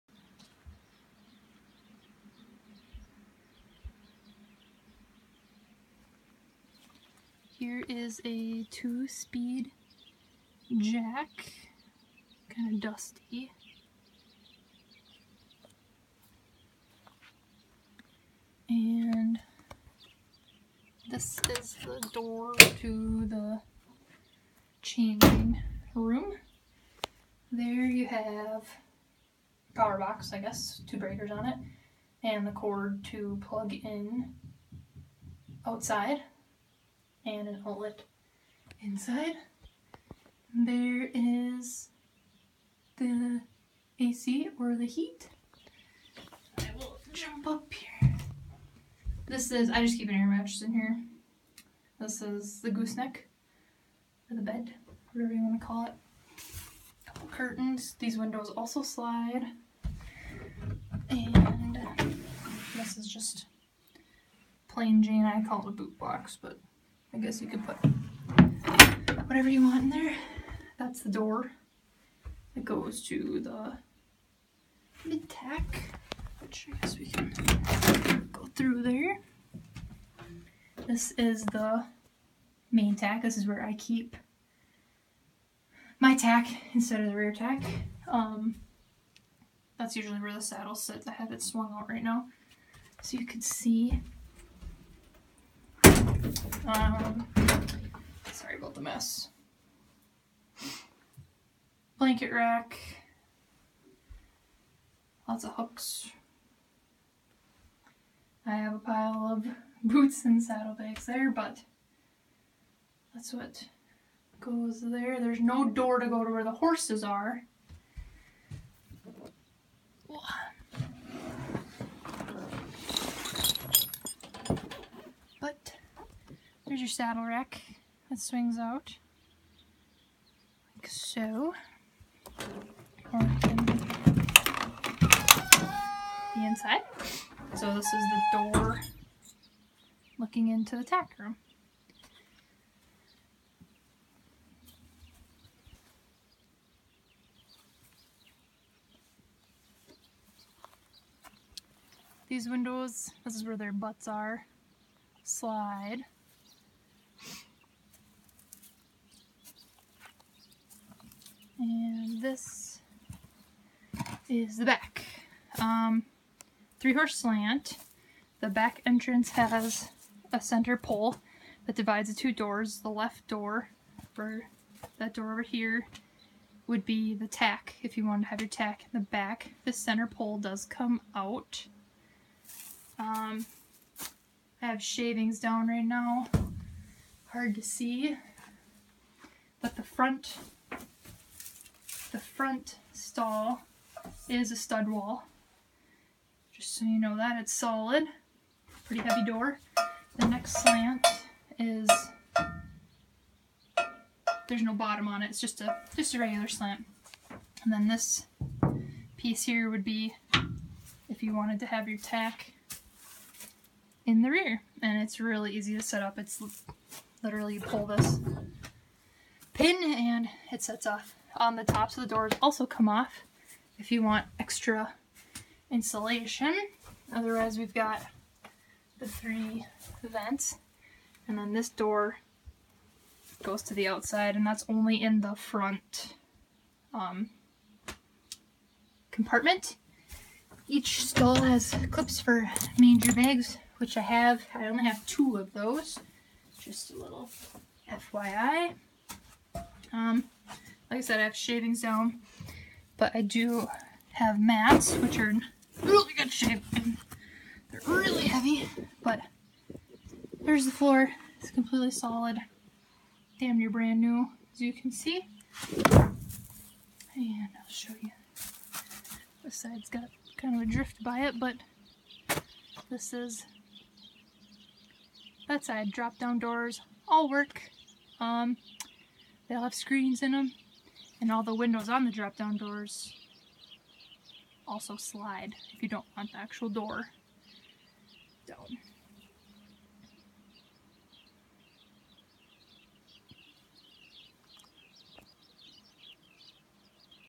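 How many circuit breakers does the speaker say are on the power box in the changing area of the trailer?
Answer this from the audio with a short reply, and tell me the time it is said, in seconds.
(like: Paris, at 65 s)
2, at 30 s.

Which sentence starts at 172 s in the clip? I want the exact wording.
The left door, for that door over here, would be the tack if you wanted to have your tack in the back.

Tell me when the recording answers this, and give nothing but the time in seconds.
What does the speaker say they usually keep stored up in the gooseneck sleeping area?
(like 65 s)
50 s.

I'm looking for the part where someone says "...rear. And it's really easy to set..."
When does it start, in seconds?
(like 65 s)
214 s.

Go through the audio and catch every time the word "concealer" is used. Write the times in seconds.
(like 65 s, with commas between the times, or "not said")
not said.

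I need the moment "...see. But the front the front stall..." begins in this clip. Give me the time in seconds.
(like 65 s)
187 s.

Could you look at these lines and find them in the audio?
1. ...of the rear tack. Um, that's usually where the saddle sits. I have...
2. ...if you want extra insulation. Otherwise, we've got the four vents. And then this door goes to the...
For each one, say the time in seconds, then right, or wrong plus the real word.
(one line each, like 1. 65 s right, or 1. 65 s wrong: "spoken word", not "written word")
1. 87 s right
2. 223 s wrong: "three", not "four".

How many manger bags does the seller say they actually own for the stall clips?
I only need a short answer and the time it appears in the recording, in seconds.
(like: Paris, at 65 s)
2, at 245 s.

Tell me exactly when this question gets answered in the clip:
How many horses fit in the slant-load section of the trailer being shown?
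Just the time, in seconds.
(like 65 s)
166 s.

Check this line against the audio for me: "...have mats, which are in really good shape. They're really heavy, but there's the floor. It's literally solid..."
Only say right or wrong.
wrong.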